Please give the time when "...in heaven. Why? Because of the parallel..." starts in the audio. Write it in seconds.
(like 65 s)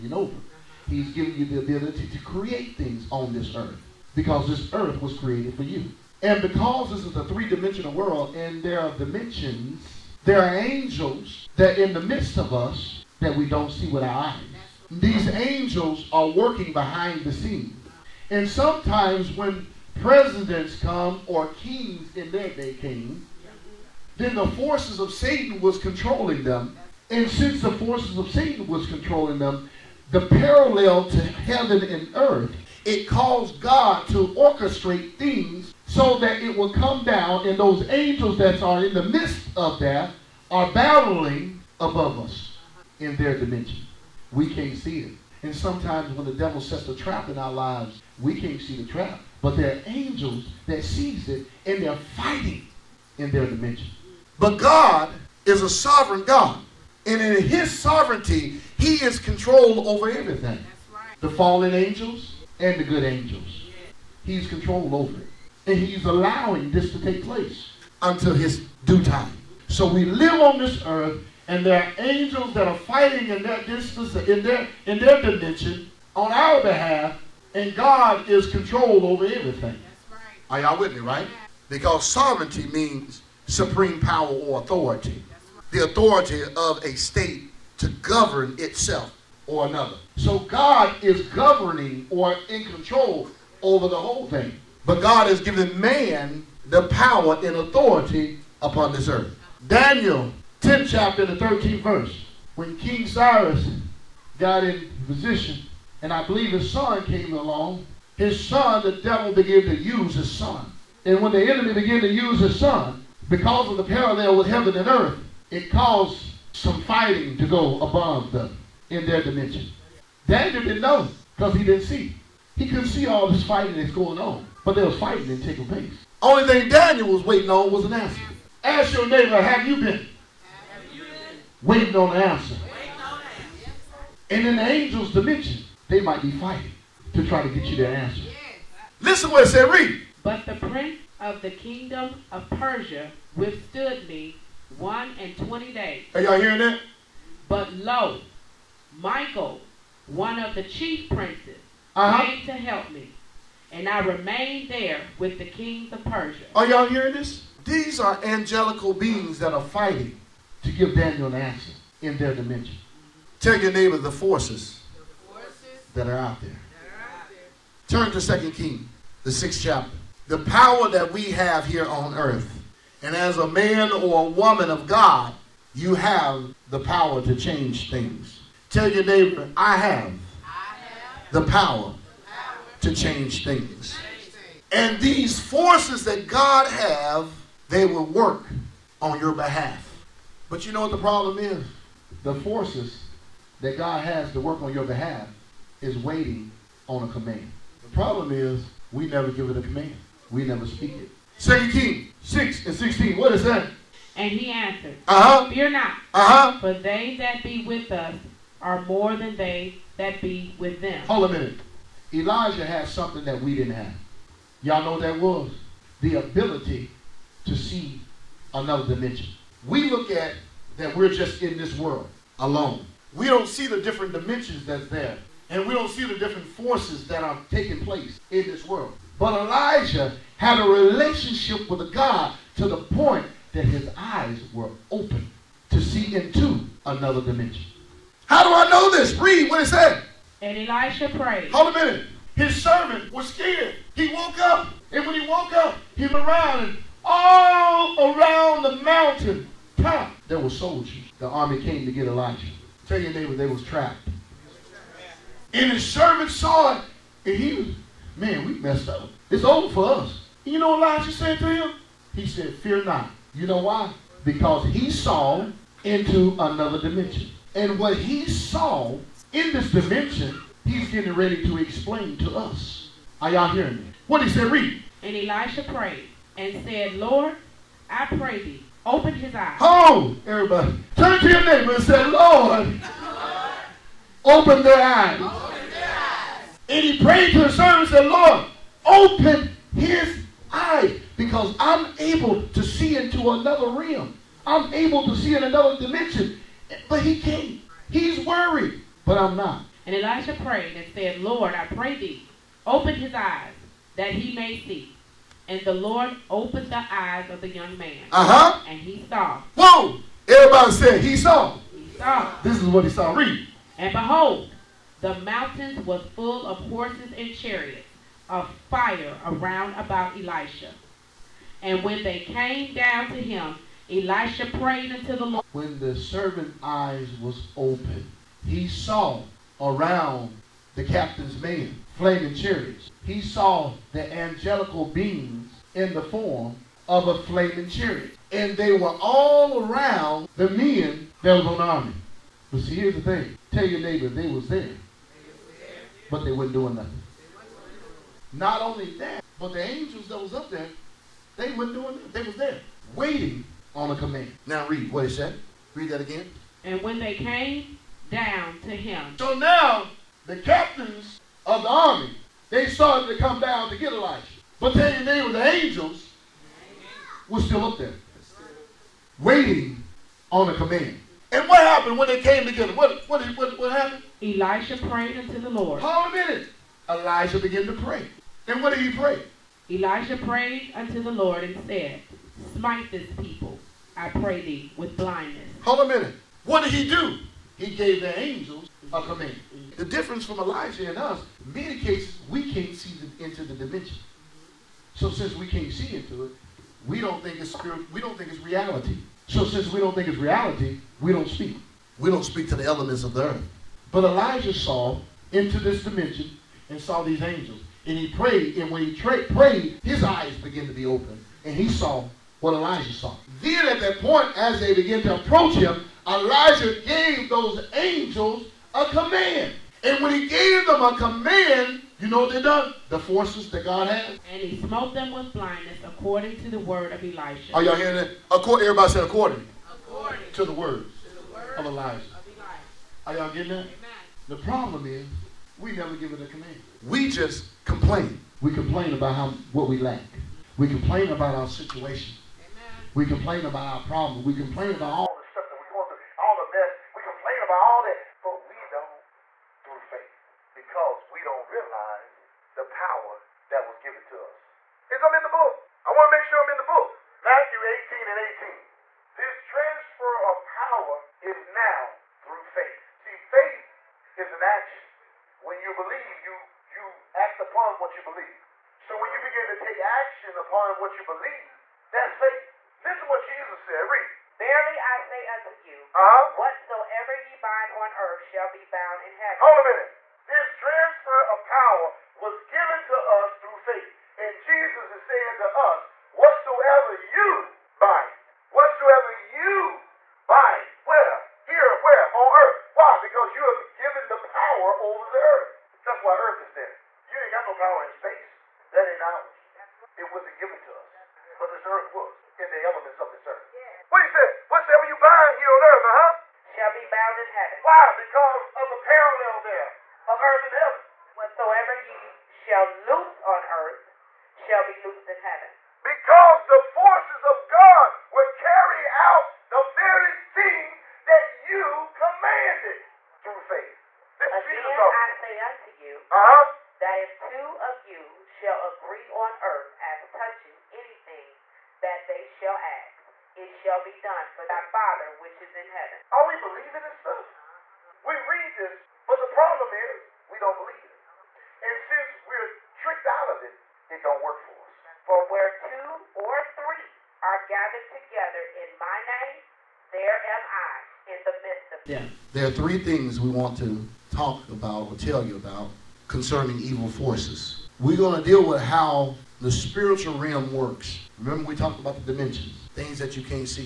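507 s.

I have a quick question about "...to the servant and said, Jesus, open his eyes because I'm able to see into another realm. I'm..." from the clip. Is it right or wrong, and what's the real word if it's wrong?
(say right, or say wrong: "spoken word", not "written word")
wrong: "Lord", not "Jesus".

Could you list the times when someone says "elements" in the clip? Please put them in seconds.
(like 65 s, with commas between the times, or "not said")
402 s, 502 s.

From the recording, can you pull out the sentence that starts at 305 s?
And the Lord opened the eyes of the young man.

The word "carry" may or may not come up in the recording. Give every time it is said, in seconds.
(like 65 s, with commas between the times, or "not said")
518 s.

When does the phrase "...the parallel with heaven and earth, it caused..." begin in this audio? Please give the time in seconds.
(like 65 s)
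113 s.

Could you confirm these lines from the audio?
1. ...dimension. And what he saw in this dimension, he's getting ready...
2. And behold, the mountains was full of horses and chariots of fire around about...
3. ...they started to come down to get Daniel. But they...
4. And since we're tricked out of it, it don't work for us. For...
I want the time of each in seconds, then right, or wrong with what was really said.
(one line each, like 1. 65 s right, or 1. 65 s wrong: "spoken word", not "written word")
1. 266 s right
2. 313 s right
3. 362 s wrong: "Elijah", not "Daniel"
4. 541 s right.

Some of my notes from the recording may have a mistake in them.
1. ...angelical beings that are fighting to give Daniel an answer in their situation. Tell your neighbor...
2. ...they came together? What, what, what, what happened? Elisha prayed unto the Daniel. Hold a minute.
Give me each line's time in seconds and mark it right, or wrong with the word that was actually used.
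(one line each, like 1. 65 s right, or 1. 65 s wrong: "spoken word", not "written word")
1. 158 s wrong: "dimension", not "situation"
2. 372 s wrong: "Lord", not "Daniel".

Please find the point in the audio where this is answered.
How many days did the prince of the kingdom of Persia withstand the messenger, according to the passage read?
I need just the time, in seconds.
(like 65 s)
144 s.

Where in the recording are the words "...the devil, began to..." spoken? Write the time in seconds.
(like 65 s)
108 s.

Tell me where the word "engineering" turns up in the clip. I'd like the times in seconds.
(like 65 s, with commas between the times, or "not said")
not said.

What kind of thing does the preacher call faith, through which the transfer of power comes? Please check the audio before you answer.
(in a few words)
An action.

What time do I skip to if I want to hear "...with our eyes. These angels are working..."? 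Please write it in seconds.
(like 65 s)
13 s.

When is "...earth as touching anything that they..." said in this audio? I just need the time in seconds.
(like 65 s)
529 s.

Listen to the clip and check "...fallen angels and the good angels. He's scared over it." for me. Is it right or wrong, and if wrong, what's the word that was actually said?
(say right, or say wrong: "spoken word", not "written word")
wrong: "controlled", not "scared".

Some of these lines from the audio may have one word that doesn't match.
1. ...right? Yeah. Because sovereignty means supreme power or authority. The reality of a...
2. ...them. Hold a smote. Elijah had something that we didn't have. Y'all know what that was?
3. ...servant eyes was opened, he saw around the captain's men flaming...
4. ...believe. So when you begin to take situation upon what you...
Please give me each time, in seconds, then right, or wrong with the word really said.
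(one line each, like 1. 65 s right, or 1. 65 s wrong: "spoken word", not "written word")
1. 80 s wrong: "authority", not "reality"
2. 210 s wrong: "minute", not "smote"
3. 325 s right
4. 468 s wrong: "action", not "situation".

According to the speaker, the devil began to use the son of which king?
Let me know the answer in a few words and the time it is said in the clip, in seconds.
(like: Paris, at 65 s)
Cyrus, at 102 s.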